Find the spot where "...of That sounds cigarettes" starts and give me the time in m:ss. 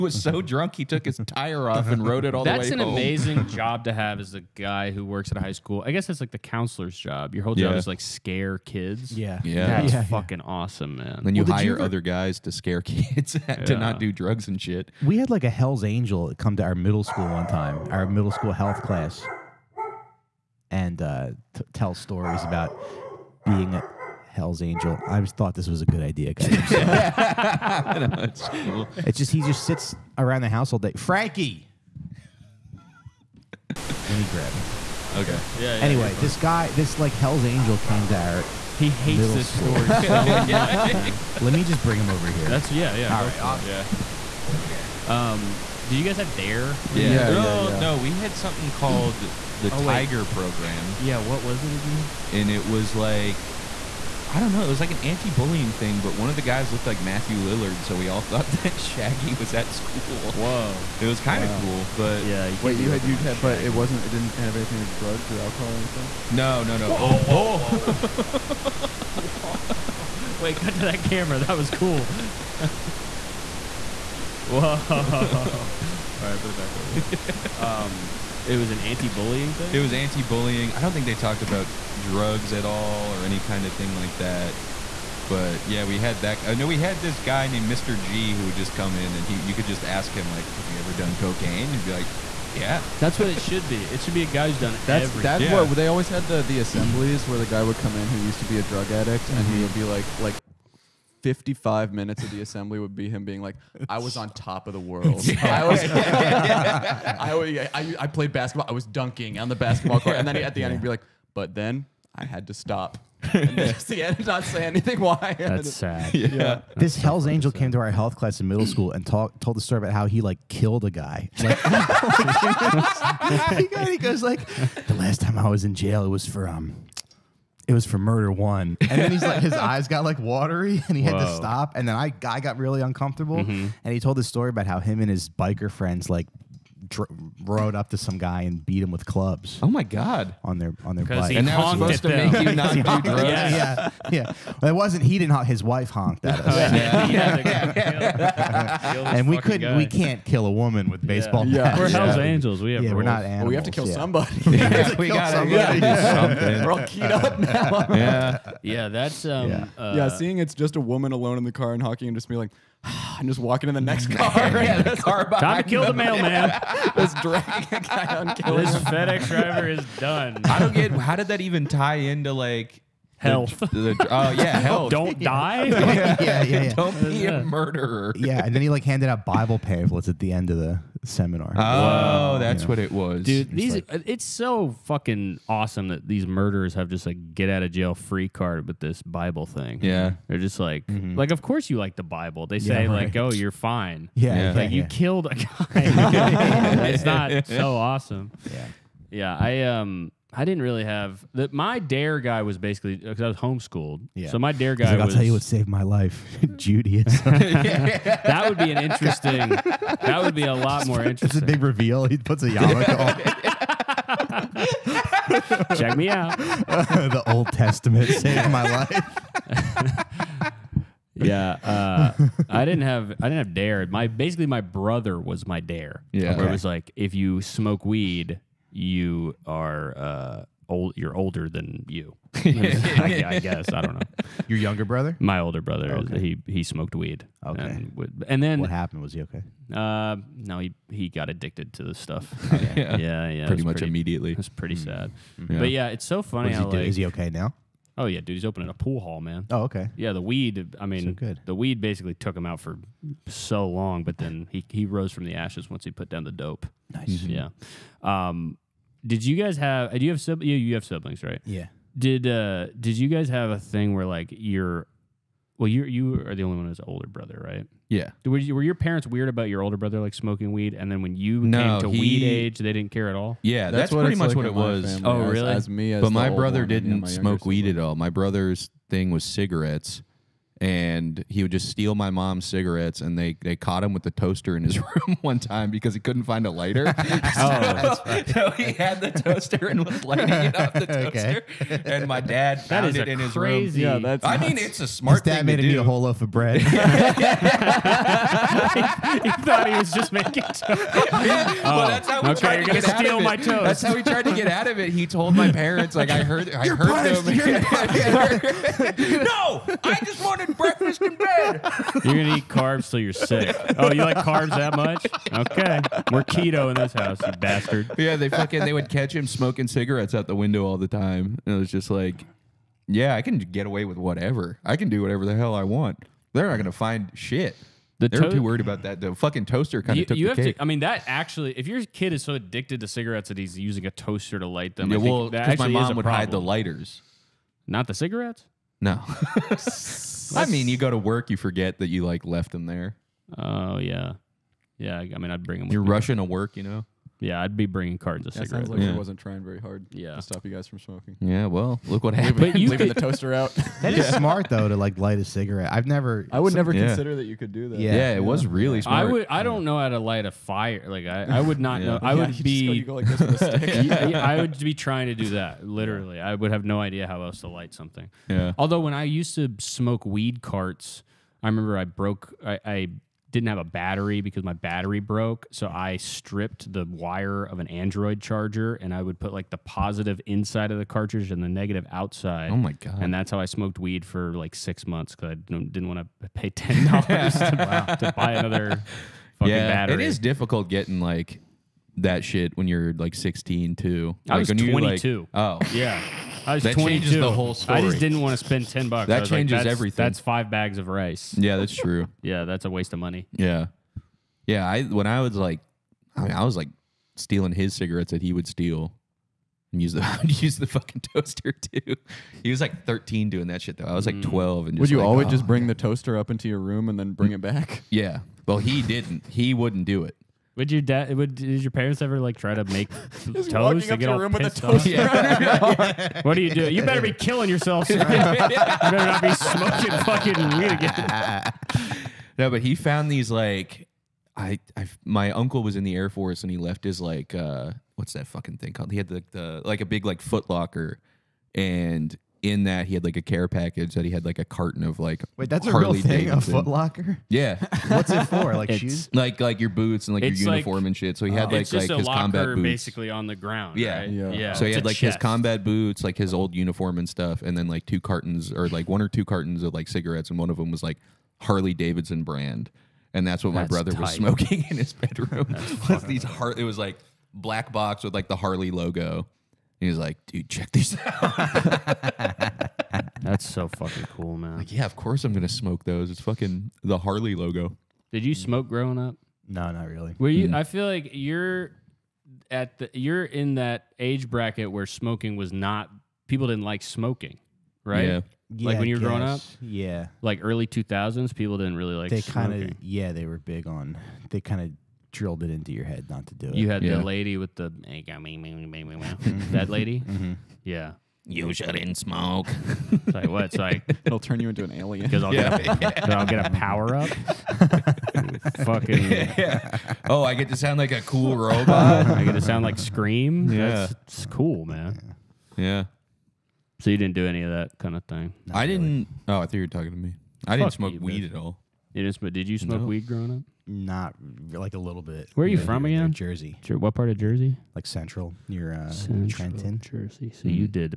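5:48.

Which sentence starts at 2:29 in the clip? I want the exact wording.
We can't kill a woman with baseball.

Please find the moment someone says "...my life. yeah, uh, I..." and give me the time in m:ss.
3:38.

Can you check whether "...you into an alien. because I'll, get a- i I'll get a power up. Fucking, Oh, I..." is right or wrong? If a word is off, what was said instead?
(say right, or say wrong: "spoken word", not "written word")
right.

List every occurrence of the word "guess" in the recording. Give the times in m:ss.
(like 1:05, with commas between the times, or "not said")
0:05, 3:53.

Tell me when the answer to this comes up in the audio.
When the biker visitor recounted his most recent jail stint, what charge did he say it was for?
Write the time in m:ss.
2:07.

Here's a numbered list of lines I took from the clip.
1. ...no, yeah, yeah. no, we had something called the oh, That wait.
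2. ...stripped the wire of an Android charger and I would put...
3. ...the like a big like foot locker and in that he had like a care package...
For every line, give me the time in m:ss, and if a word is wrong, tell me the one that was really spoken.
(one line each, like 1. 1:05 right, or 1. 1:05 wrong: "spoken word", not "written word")
1. 0:47 wrong: "Tiger", not "That"
2. 6:15 right
3. 7:19 right.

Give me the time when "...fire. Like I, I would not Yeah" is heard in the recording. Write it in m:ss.
6:00.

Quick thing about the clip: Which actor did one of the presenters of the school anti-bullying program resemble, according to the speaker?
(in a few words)
Matthew Lillard.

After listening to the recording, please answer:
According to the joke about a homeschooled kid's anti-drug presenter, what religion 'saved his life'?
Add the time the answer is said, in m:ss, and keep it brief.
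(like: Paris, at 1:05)
Judaism, at 3:26.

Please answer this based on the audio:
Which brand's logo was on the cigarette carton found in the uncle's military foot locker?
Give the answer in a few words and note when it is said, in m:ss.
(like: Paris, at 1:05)
Harley Davidson, at 7:41.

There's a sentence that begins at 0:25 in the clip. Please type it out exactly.
I just thought this was a good idea, guys.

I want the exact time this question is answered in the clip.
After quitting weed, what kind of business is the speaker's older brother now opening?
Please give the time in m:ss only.
4:08.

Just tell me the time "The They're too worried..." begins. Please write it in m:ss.
5:27.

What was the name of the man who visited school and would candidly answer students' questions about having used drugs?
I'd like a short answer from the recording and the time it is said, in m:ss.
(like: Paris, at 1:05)
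Mr. G, at 1:27.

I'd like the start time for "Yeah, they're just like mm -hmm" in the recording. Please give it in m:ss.
3:09.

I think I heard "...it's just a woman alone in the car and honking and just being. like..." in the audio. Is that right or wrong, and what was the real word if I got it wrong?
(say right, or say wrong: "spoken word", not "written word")
right.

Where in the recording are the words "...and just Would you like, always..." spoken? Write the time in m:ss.
6:54.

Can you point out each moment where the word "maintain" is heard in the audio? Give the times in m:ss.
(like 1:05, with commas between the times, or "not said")
not said.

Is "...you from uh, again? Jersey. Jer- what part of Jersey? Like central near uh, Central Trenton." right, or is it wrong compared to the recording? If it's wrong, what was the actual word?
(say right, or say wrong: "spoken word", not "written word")
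right.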